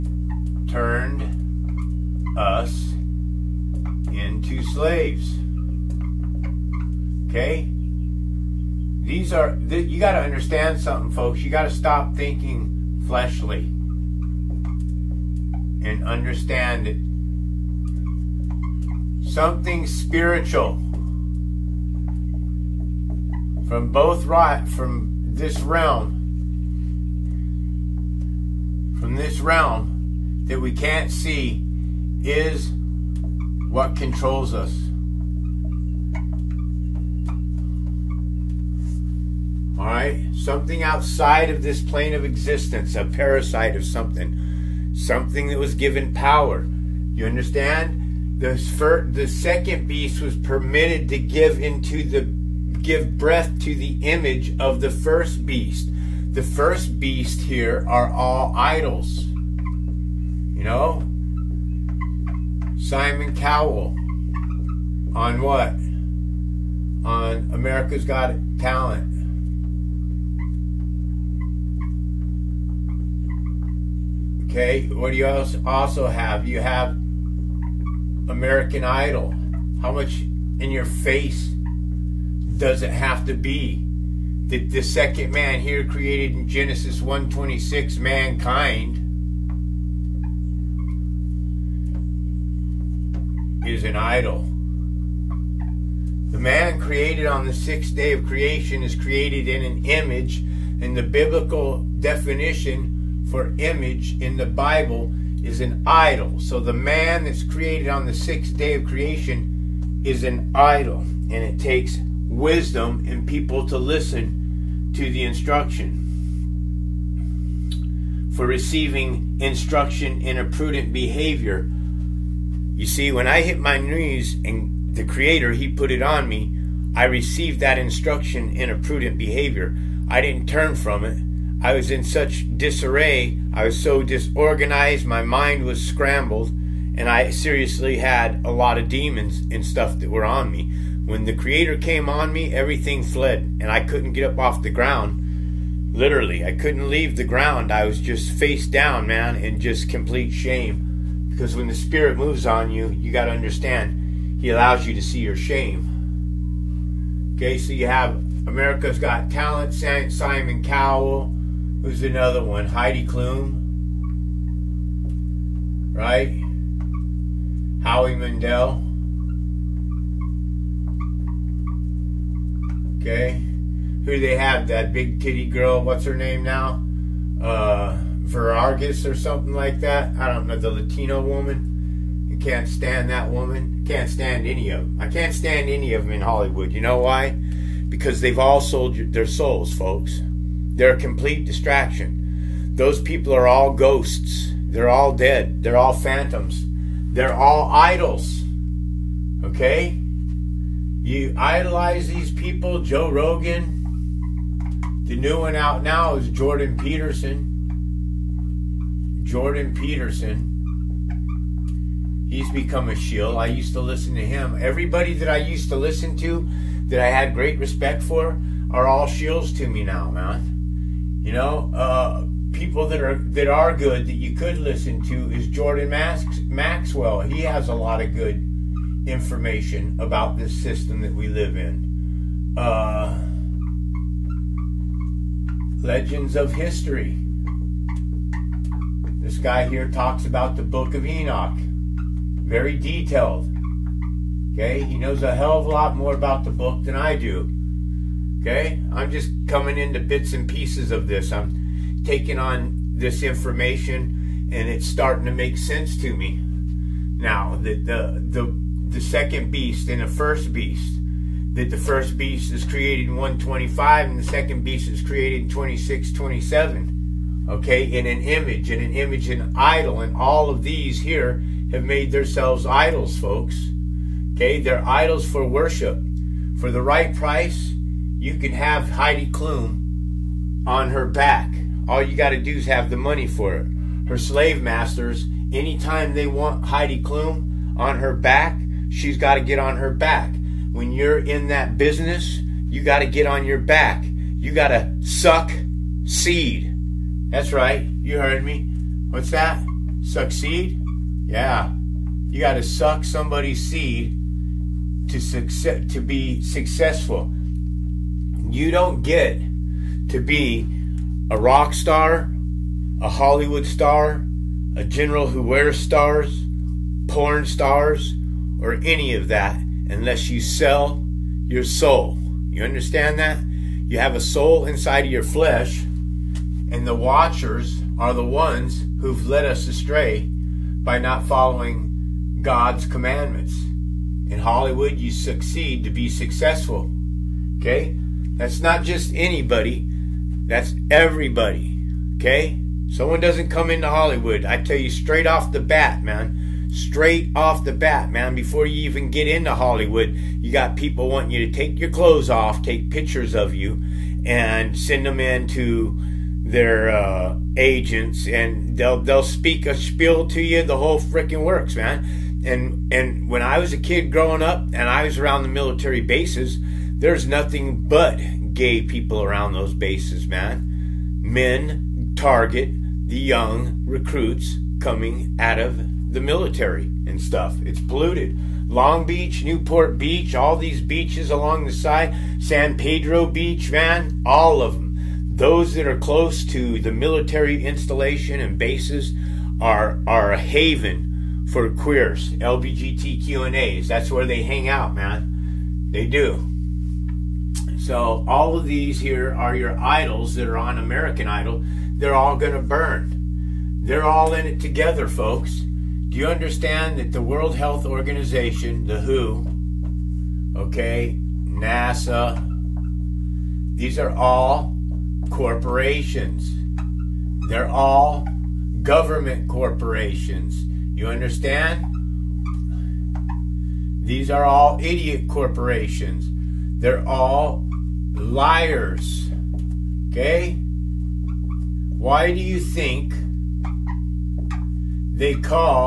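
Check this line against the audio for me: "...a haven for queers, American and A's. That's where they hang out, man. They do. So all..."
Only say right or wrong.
wrong.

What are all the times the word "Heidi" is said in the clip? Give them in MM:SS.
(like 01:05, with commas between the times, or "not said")
02:42, 04:38, 04:46.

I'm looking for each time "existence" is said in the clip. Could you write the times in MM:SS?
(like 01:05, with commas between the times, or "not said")
00:42.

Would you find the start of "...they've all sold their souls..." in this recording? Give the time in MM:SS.
03:08.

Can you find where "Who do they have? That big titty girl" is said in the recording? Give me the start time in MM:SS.
02:54.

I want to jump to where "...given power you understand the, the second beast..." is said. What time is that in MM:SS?
00:45.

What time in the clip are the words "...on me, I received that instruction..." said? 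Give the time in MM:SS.
02:06.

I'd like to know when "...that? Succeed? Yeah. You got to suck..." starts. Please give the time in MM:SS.
04:59.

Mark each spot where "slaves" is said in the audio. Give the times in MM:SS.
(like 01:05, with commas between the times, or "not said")
00:04, 04:44.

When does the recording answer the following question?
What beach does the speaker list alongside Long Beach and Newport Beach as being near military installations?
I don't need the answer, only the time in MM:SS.
06:22.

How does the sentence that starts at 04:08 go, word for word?
Okay, I'm just coming into bits and pieces of this.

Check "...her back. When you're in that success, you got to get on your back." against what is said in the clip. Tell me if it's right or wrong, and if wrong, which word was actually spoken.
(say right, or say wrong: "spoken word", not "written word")
wrong: "business", not "success".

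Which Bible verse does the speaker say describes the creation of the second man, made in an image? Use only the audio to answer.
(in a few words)
Genesis 1:26.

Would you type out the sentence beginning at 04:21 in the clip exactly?
That the first beast is created in 125 and the second beast is created in 26, 27.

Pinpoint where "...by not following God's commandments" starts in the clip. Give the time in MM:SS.
05:30.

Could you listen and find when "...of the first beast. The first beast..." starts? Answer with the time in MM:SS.
00:54.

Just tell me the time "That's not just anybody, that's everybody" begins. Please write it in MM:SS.
05:38.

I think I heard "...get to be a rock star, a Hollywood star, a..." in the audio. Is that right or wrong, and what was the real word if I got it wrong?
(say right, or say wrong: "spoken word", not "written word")
right.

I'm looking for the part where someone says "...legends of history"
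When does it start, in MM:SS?
03:55.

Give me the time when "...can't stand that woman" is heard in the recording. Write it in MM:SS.
03:02.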